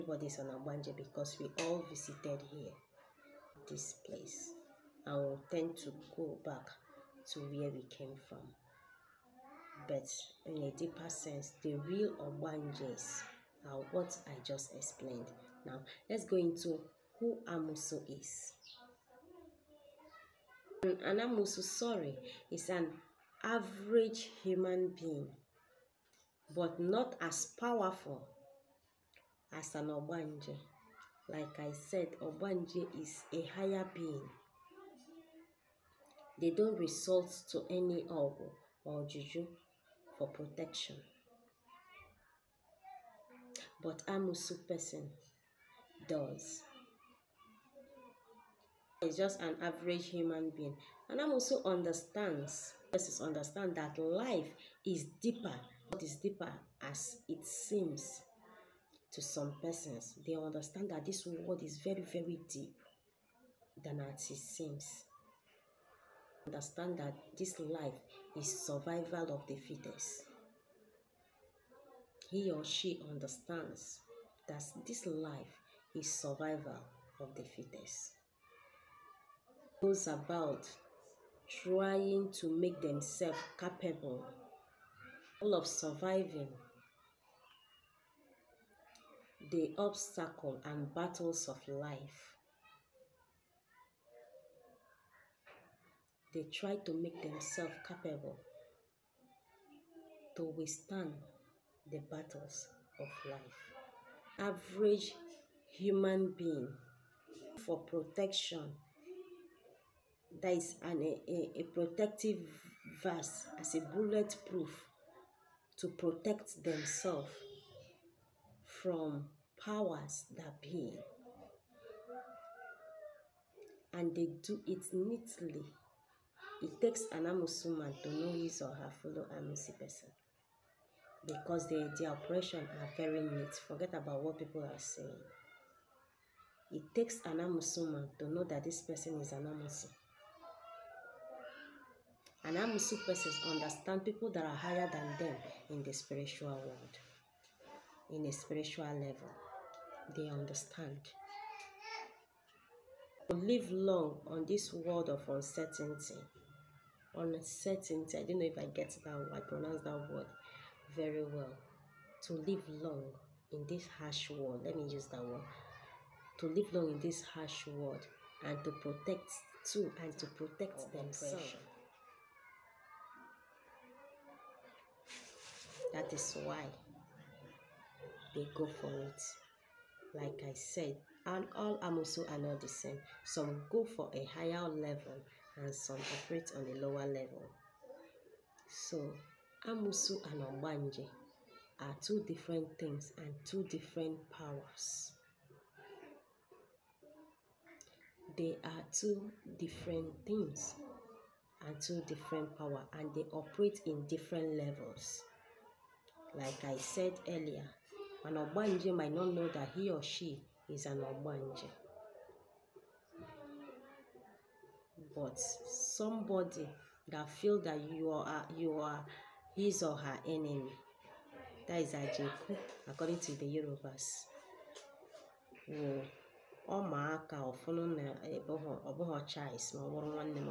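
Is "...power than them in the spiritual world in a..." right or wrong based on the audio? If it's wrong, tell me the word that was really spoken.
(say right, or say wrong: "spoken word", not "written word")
wrong: "higher", not "power".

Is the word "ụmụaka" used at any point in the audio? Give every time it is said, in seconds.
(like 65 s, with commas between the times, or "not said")
226 s.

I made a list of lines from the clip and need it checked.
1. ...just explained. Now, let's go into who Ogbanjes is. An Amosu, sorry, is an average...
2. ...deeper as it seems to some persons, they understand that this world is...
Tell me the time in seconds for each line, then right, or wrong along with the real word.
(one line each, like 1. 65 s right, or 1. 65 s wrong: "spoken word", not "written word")
1. 14 s wrong: "Amosu", not "Ogbanjes"
2. 56 s right.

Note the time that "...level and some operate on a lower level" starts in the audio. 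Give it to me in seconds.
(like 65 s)
184 s.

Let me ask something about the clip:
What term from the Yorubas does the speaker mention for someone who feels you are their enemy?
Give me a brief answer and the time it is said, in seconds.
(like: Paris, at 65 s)
Ajeku, at 221 s.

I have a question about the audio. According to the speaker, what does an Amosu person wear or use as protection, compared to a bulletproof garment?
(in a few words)
protective vest.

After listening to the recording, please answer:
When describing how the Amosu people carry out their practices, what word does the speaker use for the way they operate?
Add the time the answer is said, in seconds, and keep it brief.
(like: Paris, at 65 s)
neat, at 132 s.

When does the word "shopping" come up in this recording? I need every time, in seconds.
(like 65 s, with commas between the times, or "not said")
not said.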